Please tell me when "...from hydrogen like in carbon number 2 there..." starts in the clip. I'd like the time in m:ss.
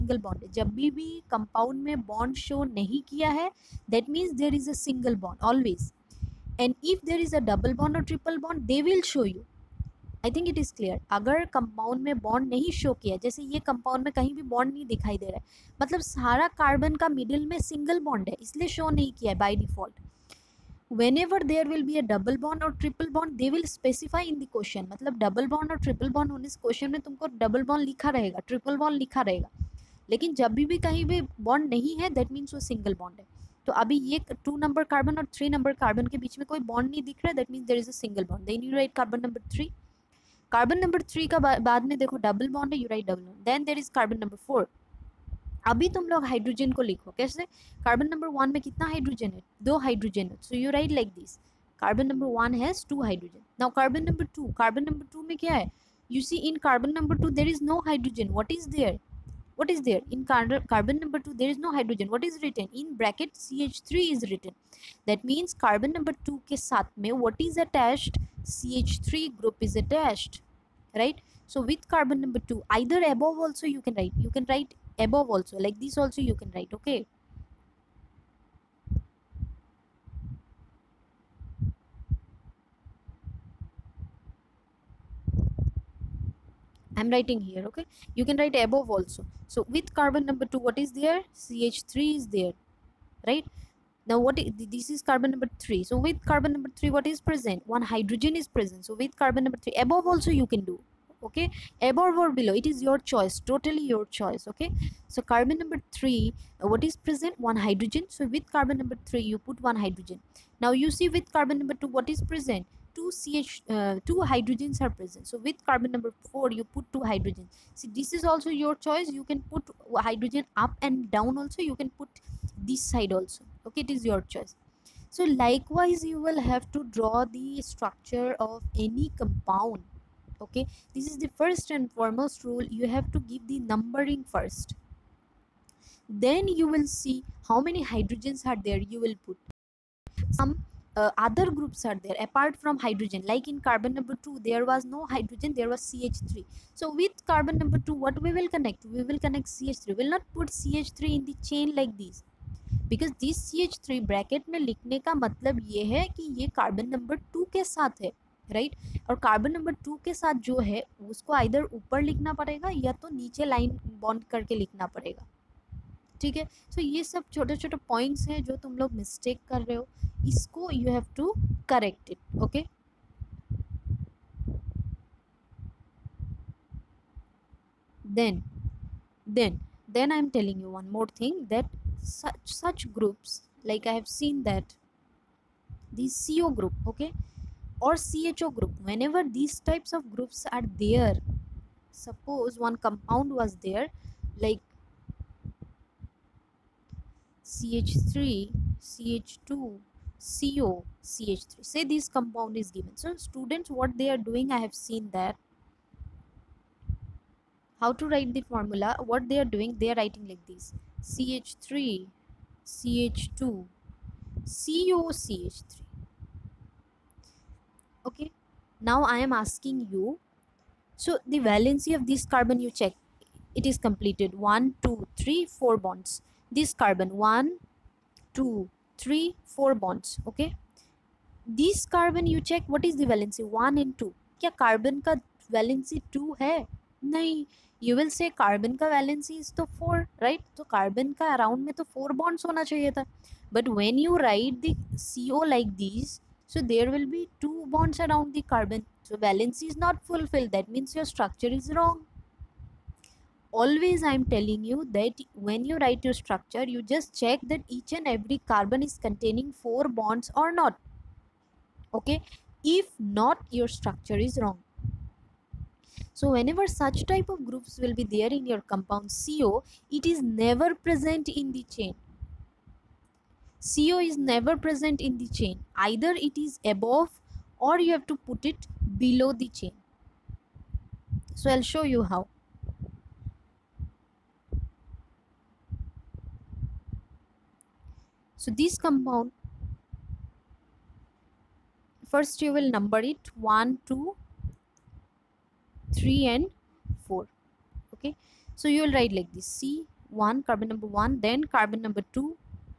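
2:22.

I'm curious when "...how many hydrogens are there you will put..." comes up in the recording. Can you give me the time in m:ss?
2:17.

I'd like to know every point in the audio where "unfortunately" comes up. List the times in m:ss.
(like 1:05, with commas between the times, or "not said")
not said.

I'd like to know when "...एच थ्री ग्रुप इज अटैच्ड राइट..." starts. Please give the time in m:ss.
1:08.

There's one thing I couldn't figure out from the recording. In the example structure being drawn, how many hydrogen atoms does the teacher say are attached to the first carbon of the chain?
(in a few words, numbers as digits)
2.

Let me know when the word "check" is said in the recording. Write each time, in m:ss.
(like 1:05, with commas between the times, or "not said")
3:42, 3:52, 4:17.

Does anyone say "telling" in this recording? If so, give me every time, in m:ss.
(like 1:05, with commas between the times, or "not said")
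3:00, 4:14.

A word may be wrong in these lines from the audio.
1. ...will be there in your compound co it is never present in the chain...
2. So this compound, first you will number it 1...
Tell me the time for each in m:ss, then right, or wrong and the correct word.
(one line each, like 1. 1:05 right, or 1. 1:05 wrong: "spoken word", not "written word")
1. 4:27 right
2. 4:48 right.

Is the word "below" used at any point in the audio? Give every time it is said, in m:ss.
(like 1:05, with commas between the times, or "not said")
1:42, 4:38.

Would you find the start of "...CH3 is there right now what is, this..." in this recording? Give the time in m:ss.
1:31.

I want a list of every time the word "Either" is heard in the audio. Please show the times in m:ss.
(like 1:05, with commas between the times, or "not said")
4:35.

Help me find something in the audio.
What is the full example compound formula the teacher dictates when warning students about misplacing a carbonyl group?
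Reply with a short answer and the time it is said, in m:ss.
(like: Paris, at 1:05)
CH3CH2COCH3, at 3:17.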